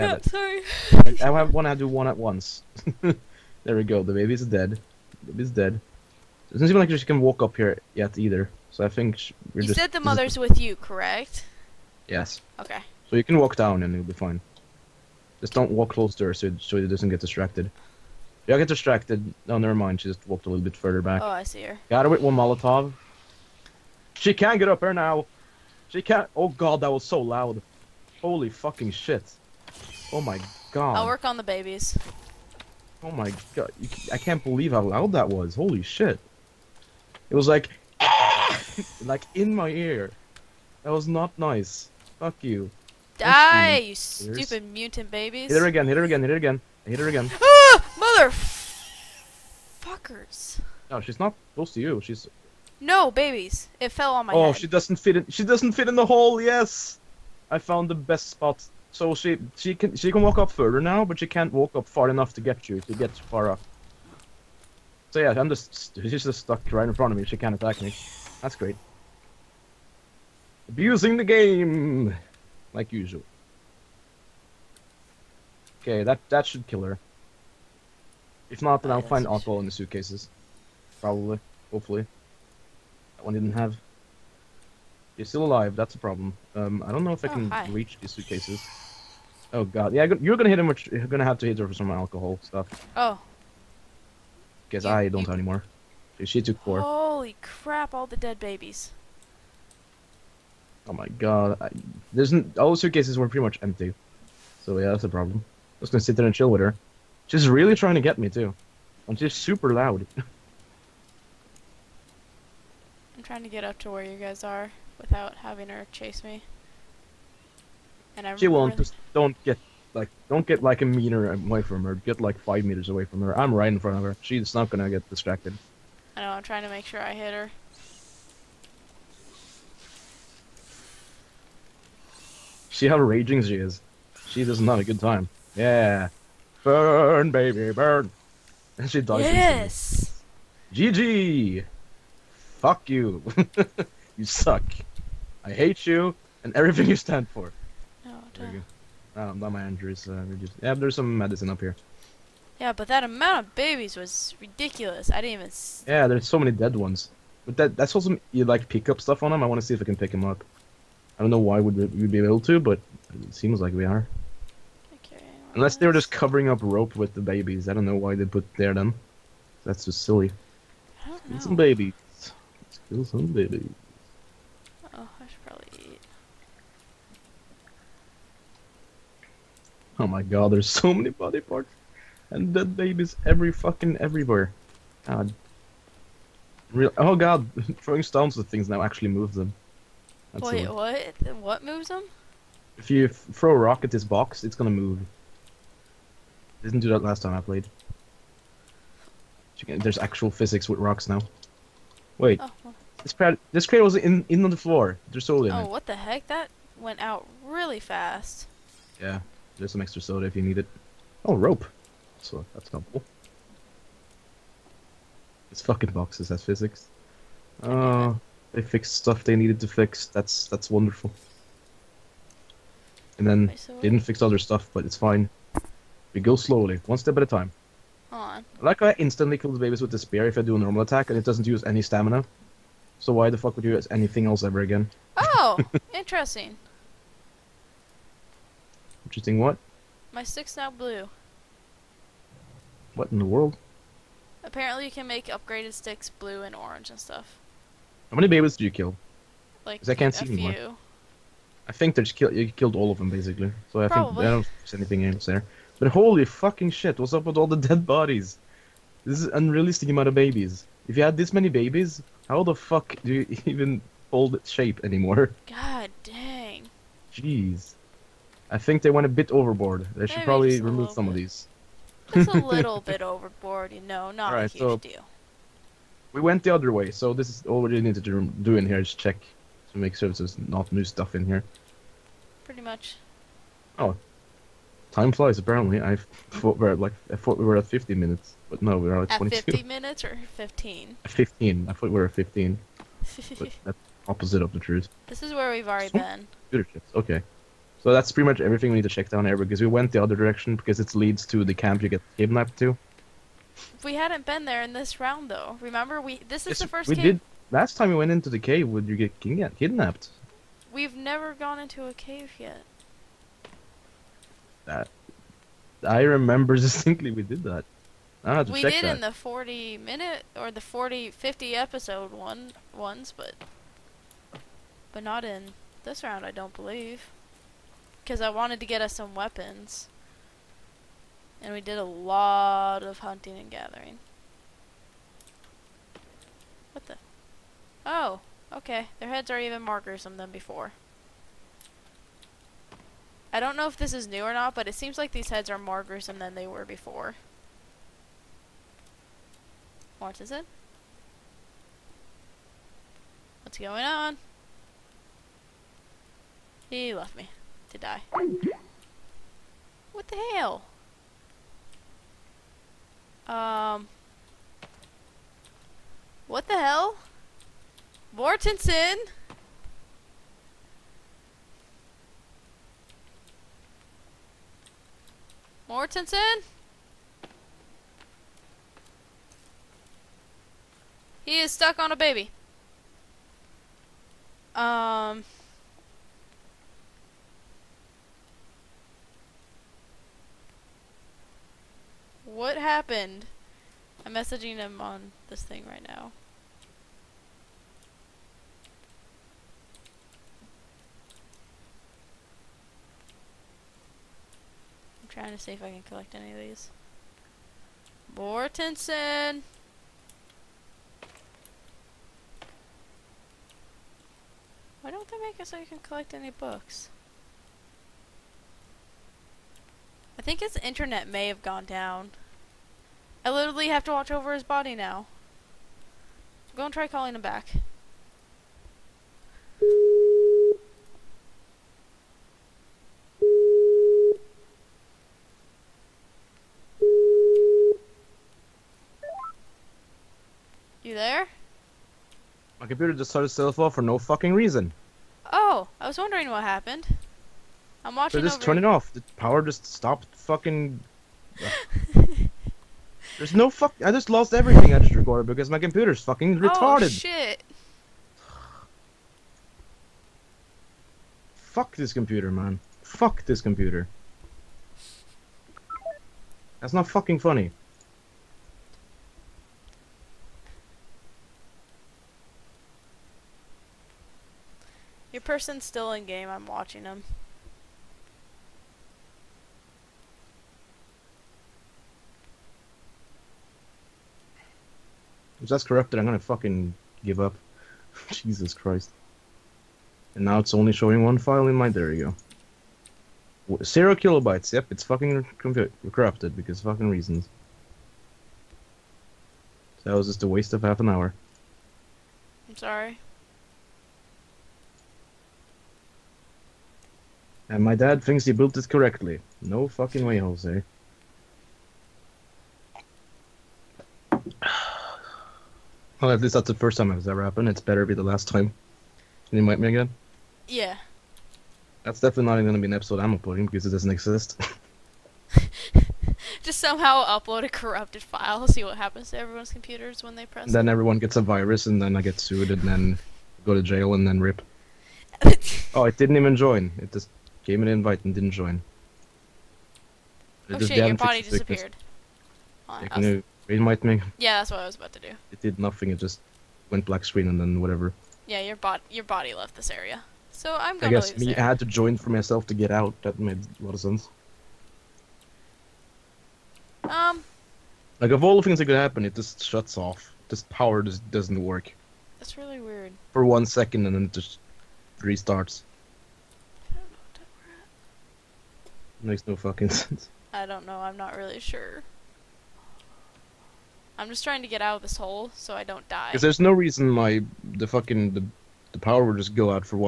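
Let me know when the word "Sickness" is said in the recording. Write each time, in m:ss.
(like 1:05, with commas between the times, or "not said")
9:02.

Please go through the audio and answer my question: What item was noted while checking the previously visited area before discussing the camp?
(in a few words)
Computer chips.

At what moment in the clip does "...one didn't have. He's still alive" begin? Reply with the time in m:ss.
1:23.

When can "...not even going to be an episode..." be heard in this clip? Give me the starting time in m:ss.
8:42.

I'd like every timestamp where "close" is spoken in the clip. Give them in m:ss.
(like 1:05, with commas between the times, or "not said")
0:15, 0:51.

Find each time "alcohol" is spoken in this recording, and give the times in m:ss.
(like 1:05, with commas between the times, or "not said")
1:19, 1:31.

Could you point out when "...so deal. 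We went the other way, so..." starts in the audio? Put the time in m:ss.
4:34.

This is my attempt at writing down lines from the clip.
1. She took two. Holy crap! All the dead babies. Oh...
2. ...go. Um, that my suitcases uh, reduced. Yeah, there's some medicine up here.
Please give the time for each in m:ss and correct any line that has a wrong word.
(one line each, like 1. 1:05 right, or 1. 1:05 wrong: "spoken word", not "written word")
1. 1:36 wrong: "four", not "two"
2. 2:29 wrong: "injuries", not "suitcases".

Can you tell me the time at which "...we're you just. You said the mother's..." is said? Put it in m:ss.
0:09.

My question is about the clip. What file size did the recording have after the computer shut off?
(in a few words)
0 kilobytes.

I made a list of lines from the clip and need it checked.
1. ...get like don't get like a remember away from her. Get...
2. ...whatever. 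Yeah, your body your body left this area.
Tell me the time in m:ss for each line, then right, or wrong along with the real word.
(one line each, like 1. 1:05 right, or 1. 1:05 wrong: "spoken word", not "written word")
1. 1:59 wrong: "meter", not "remember"
2. 9:07 right.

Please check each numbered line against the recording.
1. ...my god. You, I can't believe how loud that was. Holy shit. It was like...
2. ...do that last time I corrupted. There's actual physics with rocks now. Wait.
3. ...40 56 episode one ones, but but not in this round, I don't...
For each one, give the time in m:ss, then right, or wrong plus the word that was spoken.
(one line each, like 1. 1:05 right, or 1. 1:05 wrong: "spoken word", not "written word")
1. 0:33 right
2. 3:16 wrong: "played", not "corrupted"
3. 5:20 wrong: "50", not "56".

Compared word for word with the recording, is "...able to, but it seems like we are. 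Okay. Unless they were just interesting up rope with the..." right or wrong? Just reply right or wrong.
wrong.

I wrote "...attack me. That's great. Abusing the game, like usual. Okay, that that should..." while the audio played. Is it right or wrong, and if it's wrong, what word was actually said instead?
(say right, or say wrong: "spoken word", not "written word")
right.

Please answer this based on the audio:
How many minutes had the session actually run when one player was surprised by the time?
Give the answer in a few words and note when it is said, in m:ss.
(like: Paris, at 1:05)
22, at 4:49.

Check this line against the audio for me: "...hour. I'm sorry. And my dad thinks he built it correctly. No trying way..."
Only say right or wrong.
wrong.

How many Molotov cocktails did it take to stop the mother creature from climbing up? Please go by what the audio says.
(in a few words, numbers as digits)
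1.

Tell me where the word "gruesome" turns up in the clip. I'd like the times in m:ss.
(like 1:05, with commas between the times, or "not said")
5:39, 5:45.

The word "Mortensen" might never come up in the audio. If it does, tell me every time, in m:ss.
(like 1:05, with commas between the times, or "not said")
6:08, 6:15, 6:48.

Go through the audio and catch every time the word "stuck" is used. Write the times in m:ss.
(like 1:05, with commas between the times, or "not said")
1:06, 6:21.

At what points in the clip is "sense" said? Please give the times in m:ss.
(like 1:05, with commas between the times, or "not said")
9:13, 9:29.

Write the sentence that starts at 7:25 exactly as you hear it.
Oh, I was wondering what happened.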